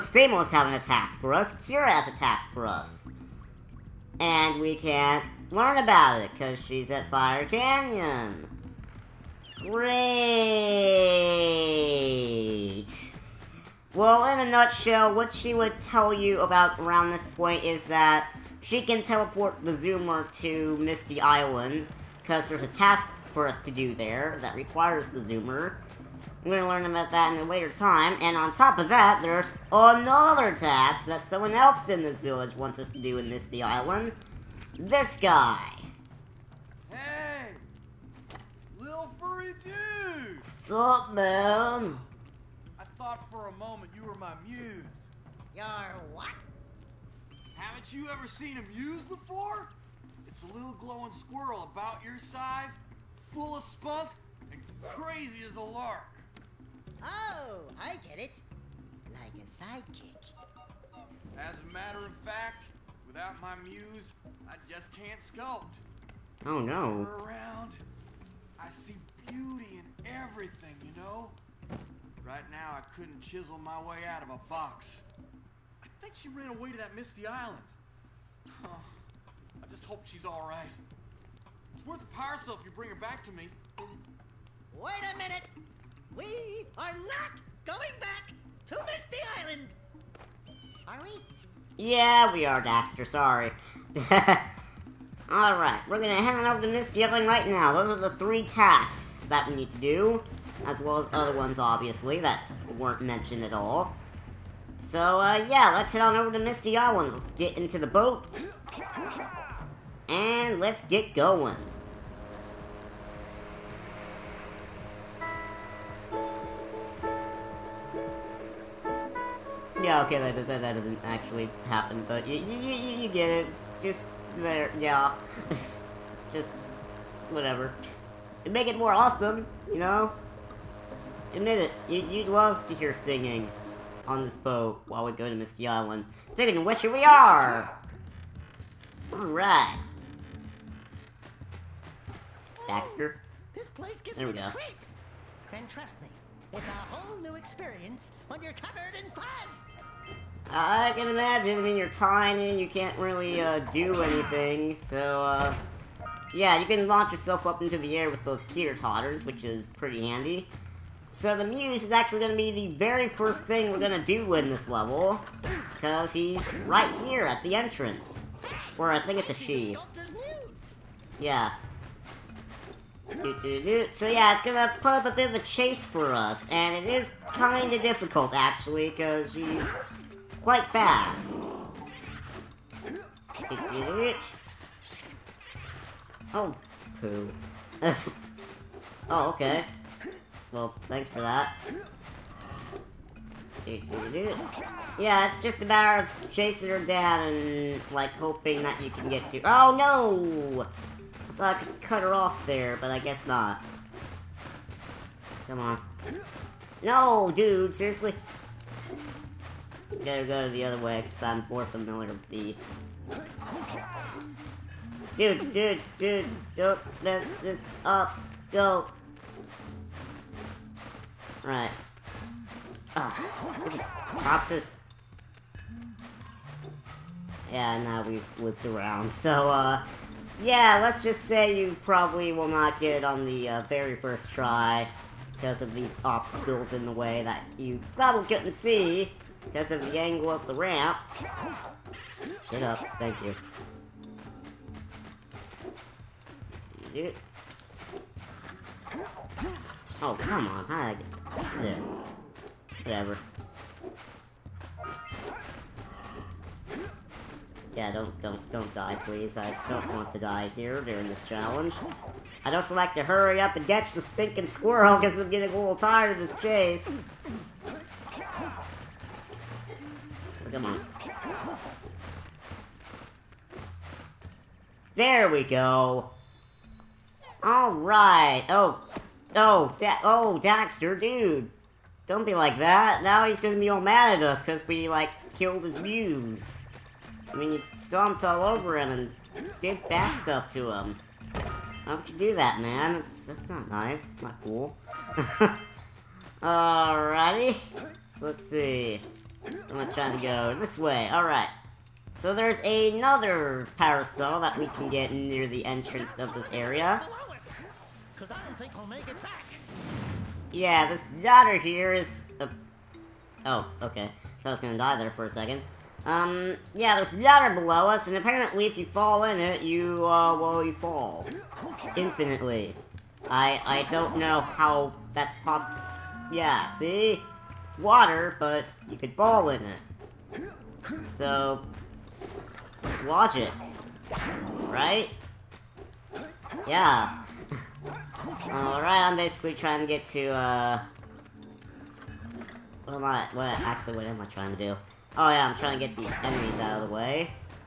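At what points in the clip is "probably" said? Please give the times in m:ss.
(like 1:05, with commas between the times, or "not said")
3:51, 3:57.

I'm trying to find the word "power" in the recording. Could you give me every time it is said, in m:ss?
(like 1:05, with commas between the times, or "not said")
1:22, 5:03.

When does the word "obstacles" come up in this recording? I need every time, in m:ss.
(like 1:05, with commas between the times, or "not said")
3:56.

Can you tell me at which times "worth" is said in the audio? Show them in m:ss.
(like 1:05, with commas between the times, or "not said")
1:21.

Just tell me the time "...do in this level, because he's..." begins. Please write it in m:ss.
2:44.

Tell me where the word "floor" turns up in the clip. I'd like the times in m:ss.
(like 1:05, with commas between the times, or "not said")
not said.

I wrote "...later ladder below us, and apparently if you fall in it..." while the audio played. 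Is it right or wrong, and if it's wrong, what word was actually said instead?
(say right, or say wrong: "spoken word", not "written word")
wrong: "water", not "later".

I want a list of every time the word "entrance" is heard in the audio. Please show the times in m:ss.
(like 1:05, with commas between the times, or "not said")
2:47, 5:05.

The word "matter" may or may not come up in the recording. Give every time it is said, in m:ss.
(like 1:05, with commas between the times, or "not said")
1:01, 3:15.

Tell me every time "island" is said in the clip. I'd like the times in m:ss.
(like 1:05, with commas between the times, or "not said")
0:21, 0:33, 1:17, 1:29, 1:37, 1:46, 2:15.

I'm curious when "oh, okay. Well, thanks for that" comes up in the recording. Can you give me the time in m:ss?
3:09.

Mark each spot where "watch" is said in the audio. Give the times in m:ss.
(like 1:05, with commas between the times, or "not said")
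5:33.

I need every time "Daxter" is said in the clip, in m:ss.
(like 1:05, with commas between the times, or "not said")
1:32, 2:22, 4:40.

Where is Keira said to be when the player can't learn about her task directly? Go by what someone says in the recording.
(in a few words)
Fire Canyon.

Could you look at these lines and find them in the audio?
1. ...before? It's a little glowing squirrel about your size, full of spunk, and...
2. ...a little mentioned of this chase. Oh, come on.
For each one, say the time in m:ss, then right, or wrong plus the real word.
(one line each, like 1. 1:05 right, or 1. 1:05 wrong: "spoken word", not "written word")
1. 0:49 right
2. 4:25 wrong: "tired", not "mentioned".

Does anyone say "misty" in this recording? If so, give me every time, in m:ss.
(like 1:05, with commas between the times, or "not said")
0:20, 0:33, 1:16, 1:28, 1:36, 1:46, 2:15.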